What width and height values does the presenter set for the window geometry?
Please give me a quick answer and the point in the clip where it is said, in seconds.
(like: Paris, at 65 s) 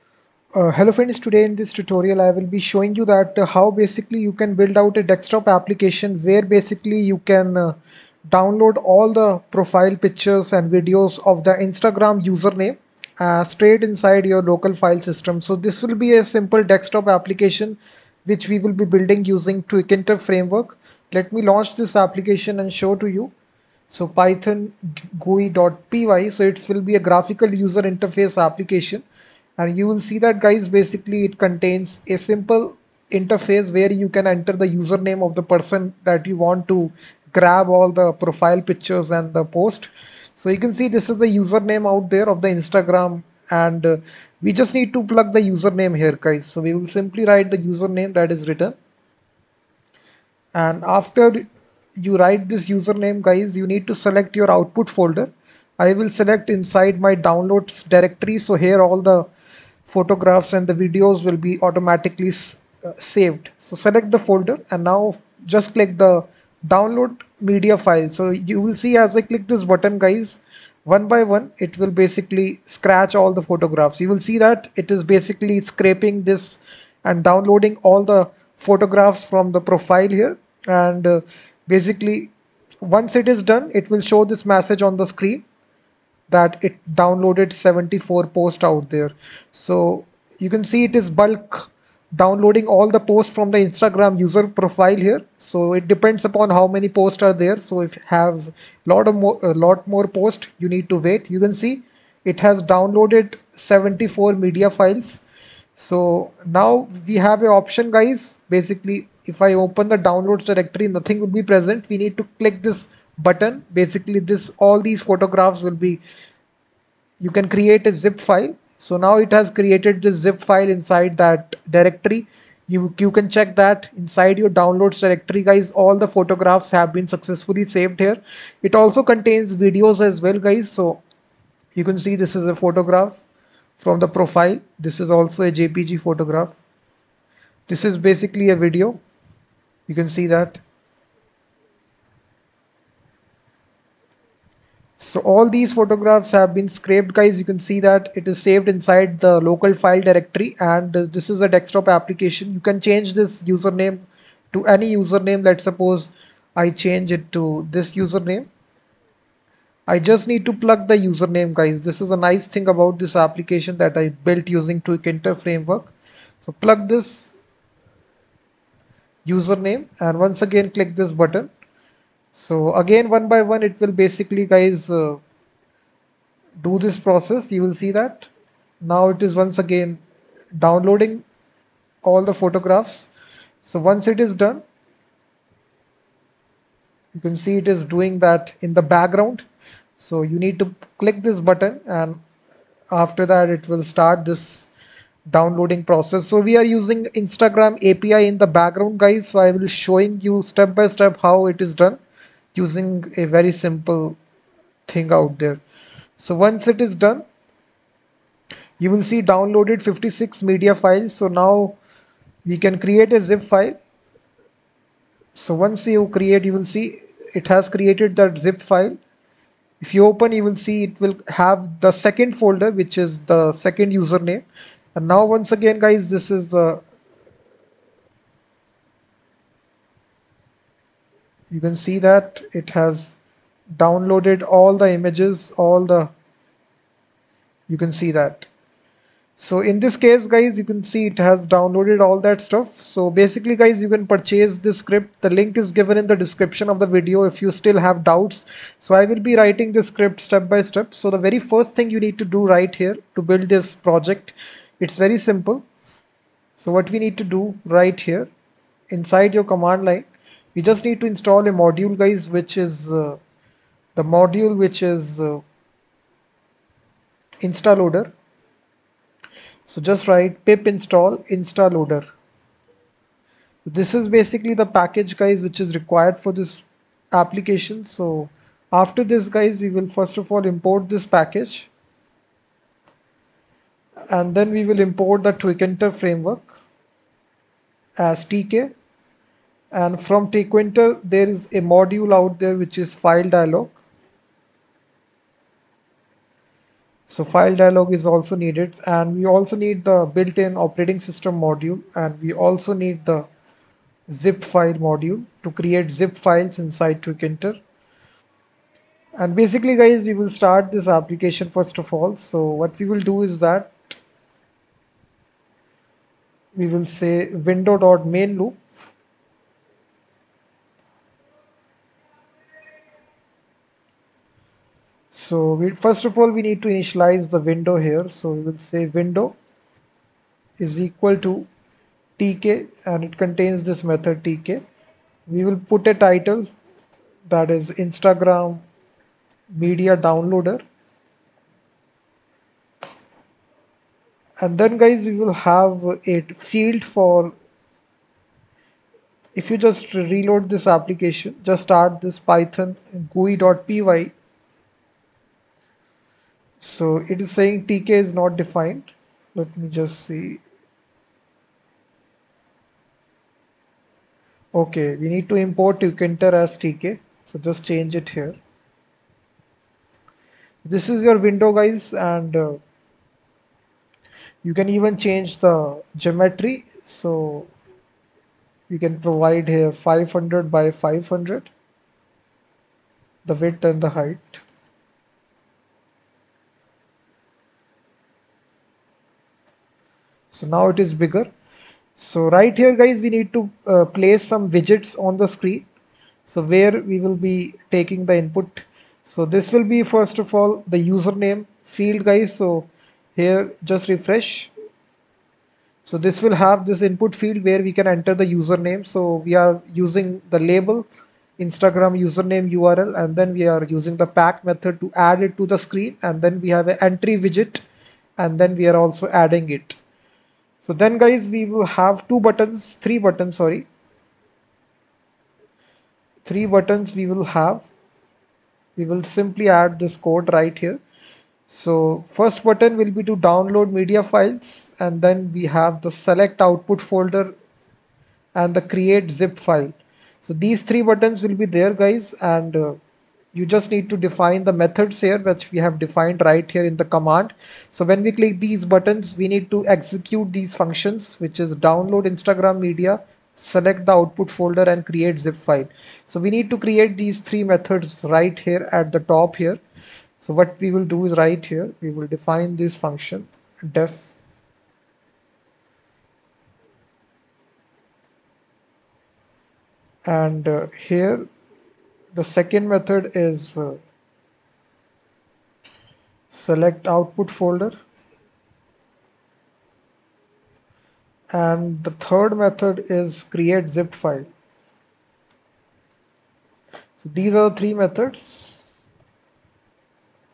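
500 by 500, at 379 s.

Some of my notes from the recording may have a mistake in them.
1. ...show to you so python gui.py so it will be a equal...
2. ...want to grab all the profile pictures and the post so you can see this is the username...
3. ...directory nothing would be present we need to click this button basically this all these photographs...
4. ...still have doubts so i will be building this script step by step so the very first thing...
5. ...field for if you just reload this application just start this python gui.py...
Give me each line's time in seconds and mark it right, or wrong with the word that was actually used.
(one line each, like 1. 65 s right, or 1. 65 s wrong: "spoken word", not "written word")
1. 22 s wrong: "graphical", not "equal"
2. 36 s right
3. 110 s right
4. 247 s wrong: "writing", not "building"
5. 346 s right.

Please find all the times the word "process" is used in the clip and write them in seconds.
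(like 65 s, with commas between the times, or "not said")
176 s, 195 s.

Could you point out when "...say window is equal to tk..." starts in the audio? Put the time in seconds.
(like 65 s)
328 s.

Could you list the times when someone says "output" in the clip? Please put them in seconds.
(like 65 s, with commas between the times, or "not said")
54 s, 436 s, 453 s, 476 s.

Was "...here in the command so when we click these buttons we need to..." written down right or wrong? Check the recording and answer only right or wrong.
right.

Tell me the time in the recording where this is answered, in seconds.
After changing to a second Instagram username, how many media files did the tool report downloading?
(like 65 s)
209 s.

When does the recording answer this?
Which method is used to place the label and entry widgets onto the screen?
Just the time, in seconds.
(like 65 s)
414 s.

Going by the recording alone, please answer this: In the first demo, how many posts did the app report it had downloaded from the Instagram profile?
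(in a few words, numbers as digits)
74.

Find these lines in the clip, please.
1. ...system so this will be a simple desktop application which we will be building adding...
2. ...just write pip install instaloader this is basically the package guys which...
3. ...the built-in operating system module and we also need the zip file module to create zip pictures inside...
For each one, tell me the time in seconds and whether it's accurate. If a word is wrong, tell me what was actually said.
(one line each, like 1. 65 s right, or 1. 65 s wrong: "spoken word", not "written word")
1. 15 s wrong: "using", not "adding"
2. 269 s right
3. 299 s wrong: "files", not "pictures".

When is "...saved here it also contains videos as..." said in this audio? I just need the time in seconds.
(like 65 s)
127 s.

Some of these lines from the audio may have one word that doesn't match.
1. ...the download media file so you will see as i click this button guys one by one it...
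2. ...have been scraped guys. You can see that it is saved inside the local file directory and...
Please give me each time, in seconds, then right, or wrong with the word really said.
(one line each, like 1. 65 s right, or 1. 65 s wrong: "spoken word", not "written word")
1. 65 s right
2. 146 s right.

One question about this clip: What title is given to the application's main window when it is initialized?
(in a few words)
Instagram Media Downloader.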